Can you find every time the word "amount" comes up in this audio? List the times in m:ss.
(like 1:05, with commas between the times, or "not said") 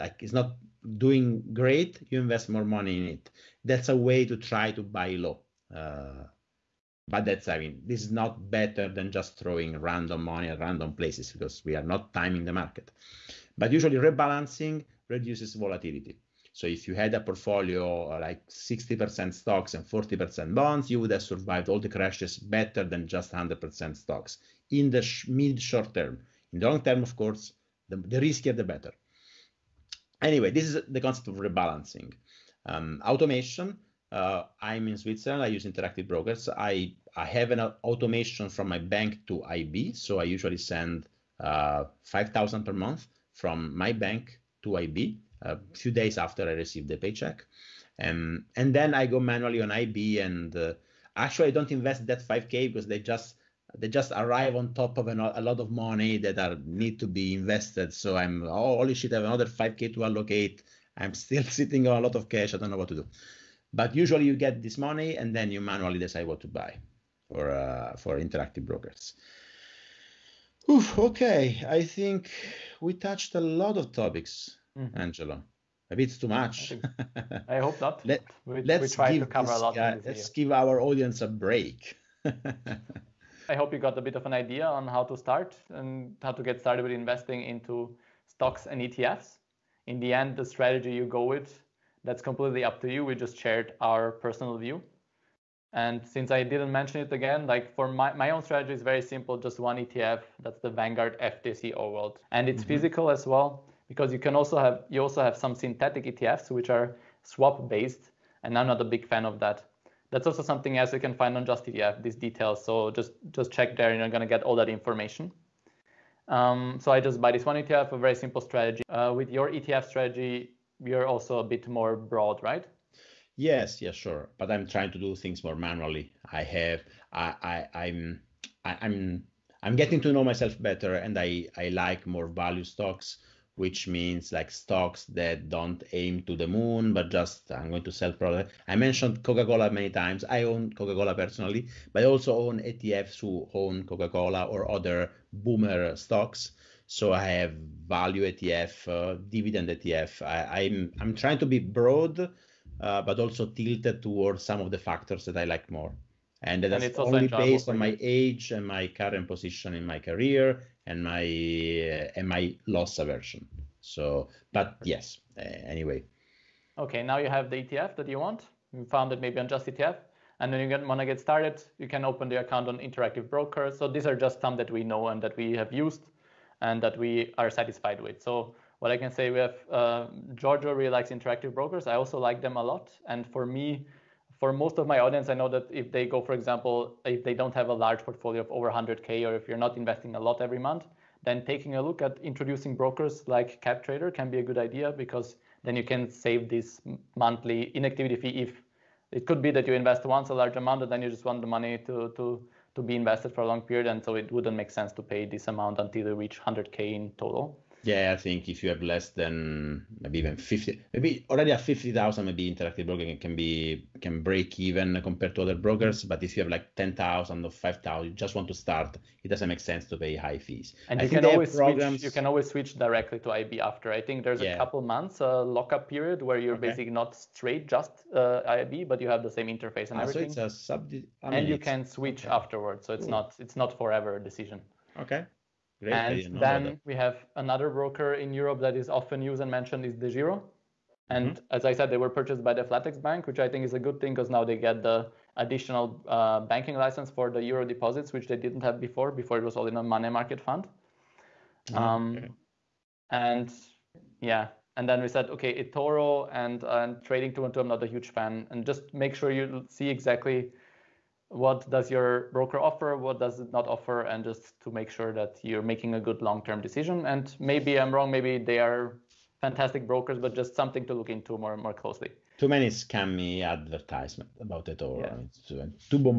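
3:20, 3:25.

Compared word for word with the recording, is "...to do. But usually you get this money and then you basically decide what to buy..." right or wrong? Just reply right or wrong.
wrong.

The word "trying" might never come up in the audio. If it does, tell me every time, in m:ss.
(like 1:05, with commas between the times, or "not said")
2:04, 2:31.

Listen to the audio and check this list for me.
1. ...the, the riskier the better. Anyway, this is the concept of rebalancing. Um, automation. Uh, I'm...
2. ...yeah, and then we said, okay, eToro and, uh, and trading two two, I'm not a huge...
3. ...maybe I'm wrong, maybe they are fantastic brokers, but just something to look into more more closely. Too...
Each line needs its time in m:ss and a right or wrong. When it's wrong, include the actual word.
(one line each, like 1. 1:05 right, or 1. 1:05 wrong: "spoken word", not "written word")
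1. 0:27 right
2. 4:14 right
3. 4:27 right.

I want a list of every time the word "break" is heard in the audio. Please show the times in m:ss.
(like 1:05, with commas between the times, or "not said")
1:21, 3:34.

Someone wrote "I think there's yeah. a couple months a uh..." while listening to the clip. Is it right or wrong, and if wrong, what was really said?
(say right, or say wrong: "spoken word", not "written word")
right.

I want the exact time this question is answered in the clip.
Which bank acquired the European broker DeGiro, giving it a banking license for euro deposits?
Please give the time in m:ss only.
4:02.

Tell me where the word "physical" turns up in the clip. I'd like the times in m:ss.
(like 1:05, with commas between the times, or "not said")
1:42.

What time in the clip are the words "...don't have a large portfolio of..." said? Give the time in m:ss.
3:07.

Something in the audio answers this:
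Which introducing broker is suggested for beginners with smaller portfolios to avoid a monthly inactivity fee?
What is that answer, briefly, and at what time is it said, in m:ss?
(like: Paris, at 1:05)
CapTrader, at 3:13.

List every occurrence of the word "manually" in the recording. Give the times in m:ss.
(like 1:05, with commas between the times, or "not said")
0:49, 1:05, 2:05.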